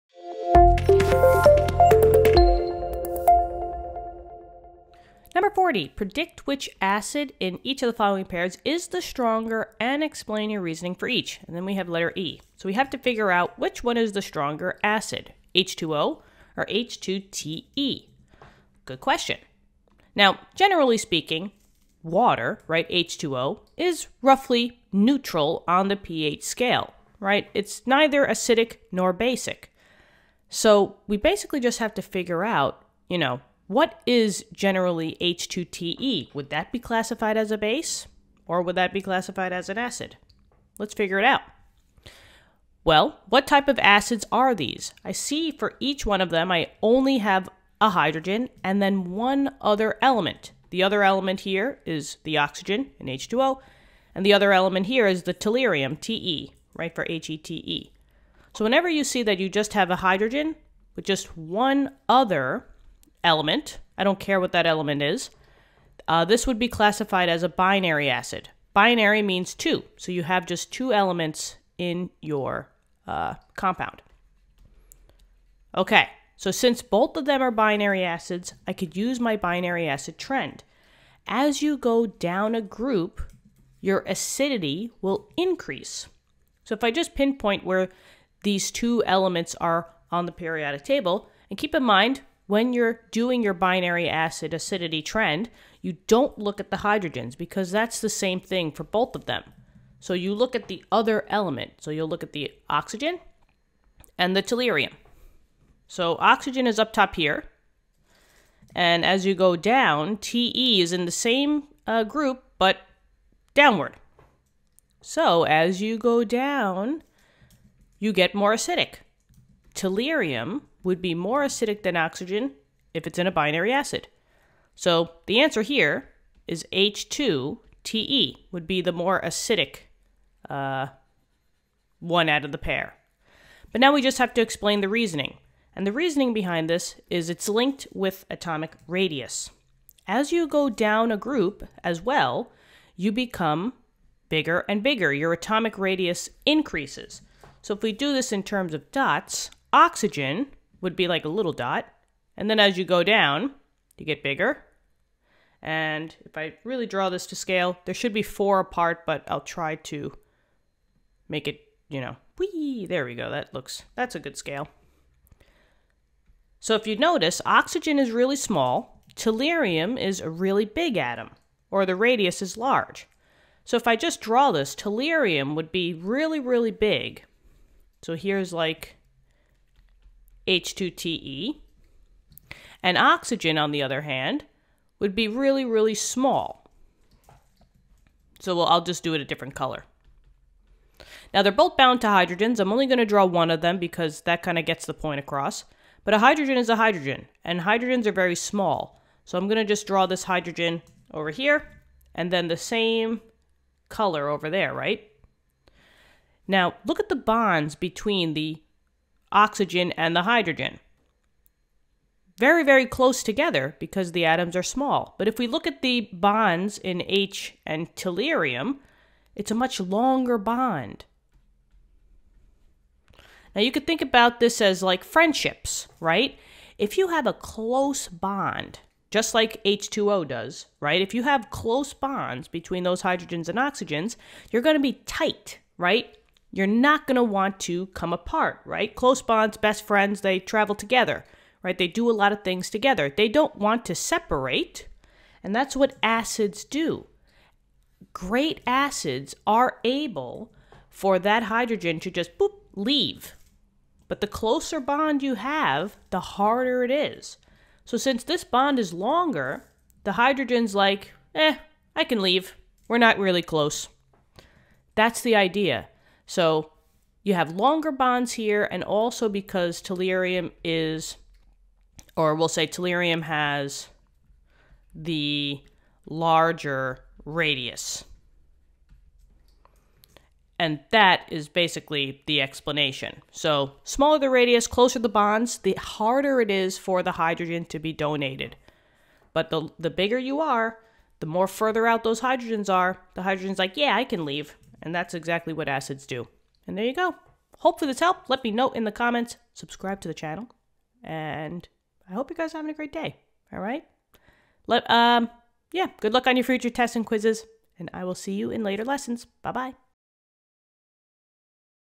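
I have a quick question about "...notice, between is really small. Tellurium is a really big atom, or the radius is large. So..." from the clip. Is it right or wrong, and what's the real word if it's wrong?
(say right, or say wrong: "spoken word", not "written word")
wrong: "oxygen", not "between".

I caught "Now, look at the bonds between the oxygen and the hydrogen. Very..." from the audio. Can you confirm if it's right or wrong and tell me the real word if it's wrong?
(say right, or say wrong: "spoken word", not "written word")
right.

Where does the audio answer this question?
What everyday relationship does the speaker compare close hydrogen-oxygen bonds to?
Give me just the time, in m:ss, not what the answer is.
3:45.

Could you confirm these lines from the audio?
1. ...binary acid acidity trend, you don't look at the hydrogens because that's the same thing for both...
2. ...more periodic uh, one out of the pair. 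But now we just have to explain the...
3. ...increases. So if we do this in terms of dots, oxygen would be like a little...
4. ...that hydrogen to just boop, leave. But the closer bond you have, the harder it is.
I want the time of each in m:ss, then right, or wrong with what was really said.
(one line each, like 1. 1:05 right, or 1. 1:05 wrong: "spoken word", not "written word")
1. 1:33 right
2. 2:08 wrong: "acidic", not "periodic"
3. 2:26 right
4. 4:11 right.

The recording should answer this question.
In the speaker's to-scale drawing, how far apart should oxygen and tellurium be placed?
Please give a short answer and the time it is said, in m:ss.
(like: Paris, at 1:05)
4, at 2:38.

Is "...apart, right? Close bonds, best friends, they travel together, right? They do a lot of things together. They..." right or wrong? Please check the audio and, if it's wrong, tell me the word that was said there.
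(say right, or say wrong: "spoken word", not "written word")
right.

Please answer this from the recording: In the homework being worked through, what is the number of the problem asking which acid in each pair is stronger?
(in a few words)
40.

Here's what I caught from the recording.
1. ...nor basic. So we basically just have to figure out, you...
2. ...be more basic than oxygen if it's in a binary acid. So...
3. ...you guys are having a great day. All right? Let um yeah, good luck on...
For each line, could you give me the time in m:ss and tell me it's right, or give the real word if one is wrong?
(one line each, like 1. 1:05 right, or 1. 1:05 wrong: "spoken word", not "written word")
1. 0:28 right
2. 2:01 wrong: "acidic", not "basic"
3. 5:02 right.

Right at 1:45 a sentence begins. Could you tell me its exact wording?
So oxygen is up top here.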